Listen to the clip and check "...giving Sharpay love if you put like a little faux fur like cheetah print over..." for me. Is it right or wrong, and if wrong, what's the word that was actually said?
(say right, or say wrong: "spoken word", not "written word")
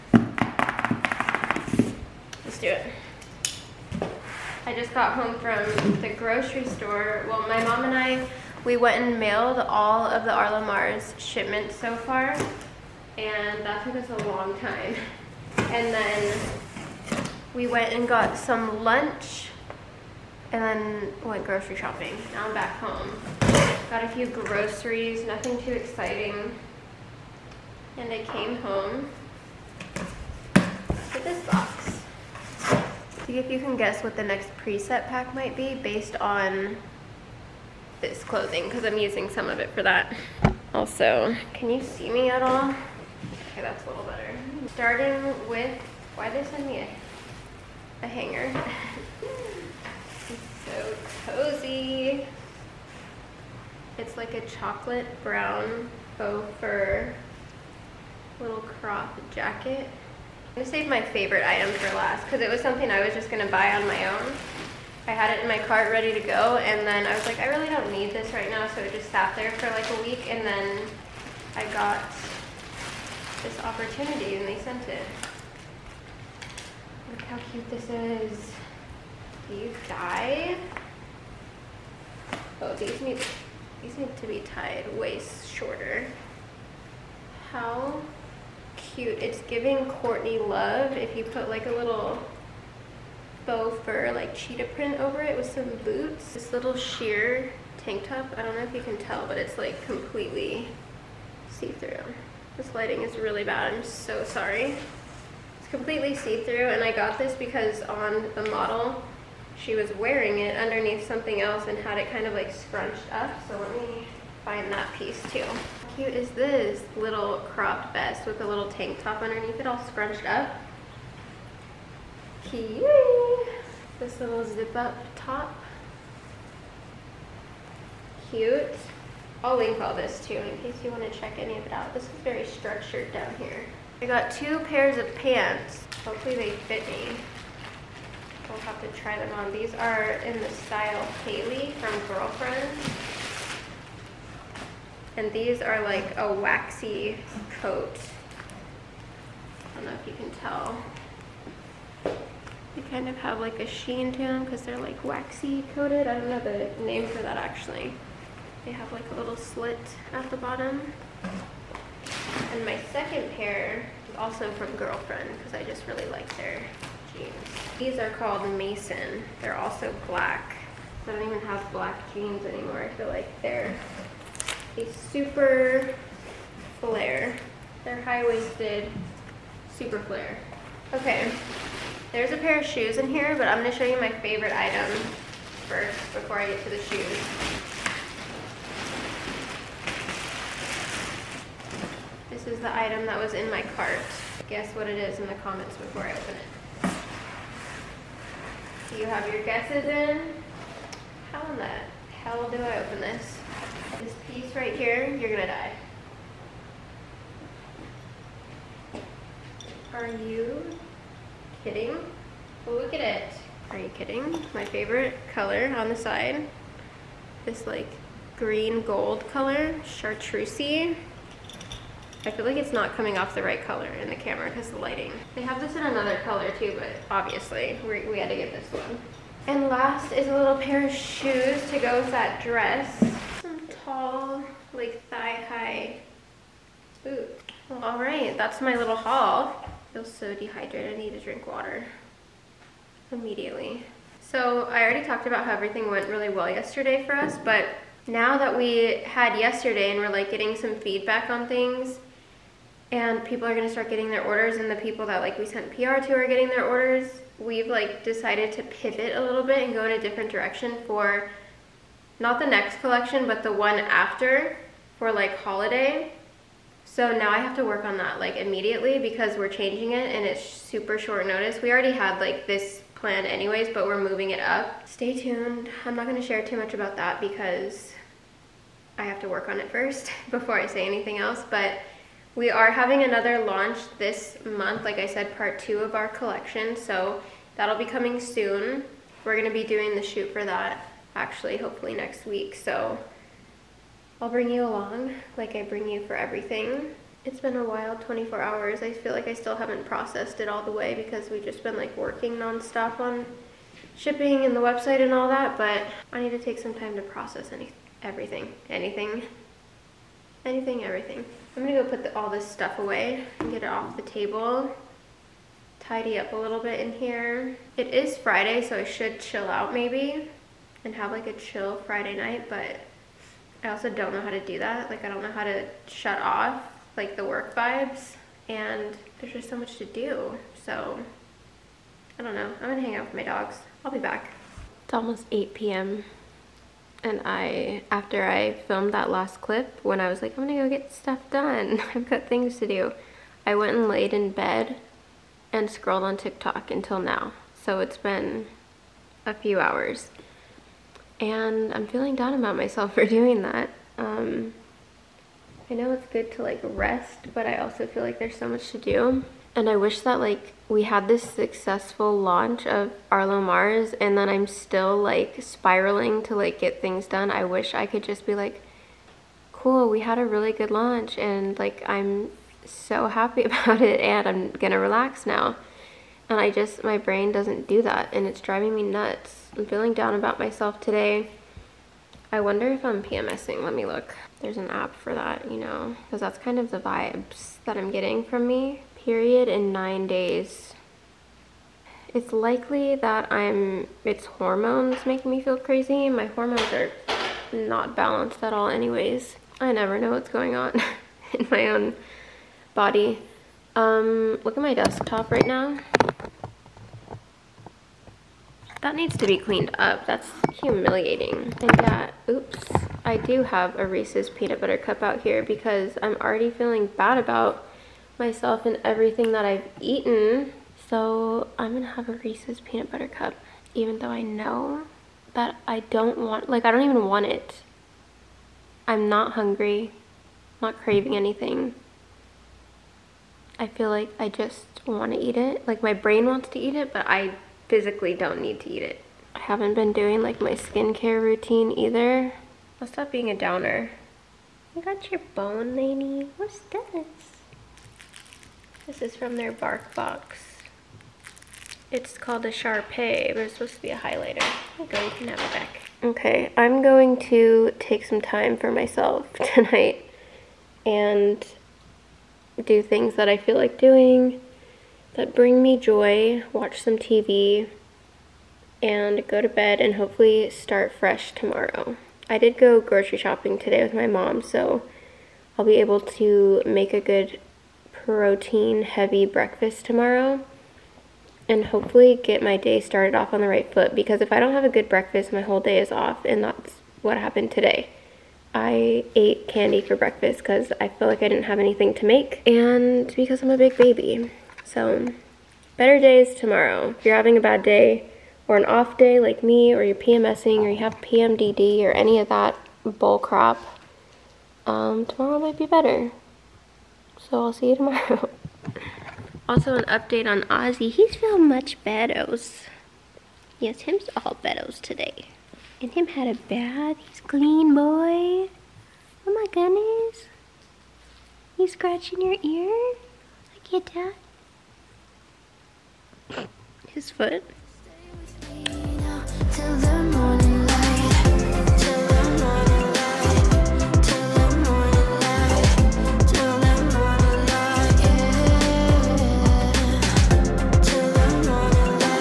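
wrong: "Courtney", not "Sharpay".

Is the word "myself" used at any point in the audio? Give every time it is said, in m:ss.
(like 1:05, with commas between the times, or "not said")
5:52, 6:20, 6:58, 7:38.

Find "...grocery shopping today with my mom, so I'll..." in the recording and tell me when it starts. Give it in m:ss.
7:52.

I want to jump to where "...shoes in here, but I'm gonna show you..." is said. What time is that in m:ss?
3:02.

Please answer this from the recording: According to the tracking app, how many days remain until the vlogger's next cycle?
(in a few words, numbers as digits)
9.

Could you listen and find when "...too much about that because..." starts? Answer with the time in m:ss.
4:36.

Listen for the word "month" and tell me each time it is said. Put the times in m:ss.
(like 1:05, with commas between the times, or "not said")
4:44.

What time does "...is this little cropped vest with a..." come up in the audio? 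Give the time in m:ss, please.
1:56.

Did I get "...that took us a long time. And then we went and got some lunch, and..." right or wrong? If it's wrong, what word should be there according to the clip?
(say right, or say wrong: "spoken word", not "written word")
right.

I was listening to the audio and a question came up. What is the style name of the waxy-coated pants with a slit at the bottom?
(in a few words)
Hailey.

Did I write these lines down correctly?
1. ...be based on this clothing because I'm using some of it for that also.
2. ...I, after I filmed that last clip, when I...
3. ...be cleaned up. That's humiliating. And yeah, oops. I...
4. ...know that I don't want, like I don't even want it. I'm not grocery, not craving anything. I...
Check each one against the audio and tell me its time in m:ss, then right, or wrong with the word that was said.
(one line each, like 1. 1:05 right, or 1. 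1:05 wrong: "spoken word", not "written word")
1. 0:35 right
2. 5:37 right
3. 6:49 right
4. 7:04 wrong: "hungry", not "grocery".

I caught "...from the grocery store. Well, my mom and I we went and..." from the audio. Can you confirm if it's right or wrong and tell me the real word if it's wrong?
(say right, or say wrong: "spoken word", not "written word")
right.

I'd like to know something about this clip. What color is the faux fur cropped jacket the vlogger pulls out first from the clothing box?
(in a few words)
Chocolate brown.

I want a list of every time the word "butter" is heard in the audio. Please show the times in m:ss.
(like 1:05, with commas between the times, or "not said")
6:54, 7:02.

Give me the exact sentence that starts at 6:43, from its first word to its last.
Um, look at my desktop right now.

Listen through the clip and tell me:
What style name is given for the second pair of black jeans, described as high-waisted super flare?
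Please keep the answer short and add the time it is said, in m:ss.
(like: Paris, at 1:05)
Mason, at 2:48.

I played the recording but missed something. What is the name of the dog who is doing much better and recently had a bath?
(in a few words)
Ozzy.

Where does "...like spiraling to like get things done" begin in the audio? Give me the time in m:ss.
6:04.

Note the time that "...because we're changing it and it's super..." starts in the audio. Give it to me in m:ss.
4:28.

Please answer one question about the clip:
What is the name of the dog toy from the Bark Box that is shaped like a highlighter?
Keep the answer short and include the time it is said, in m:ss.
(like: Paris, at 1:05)
Sharpay, at 7:32.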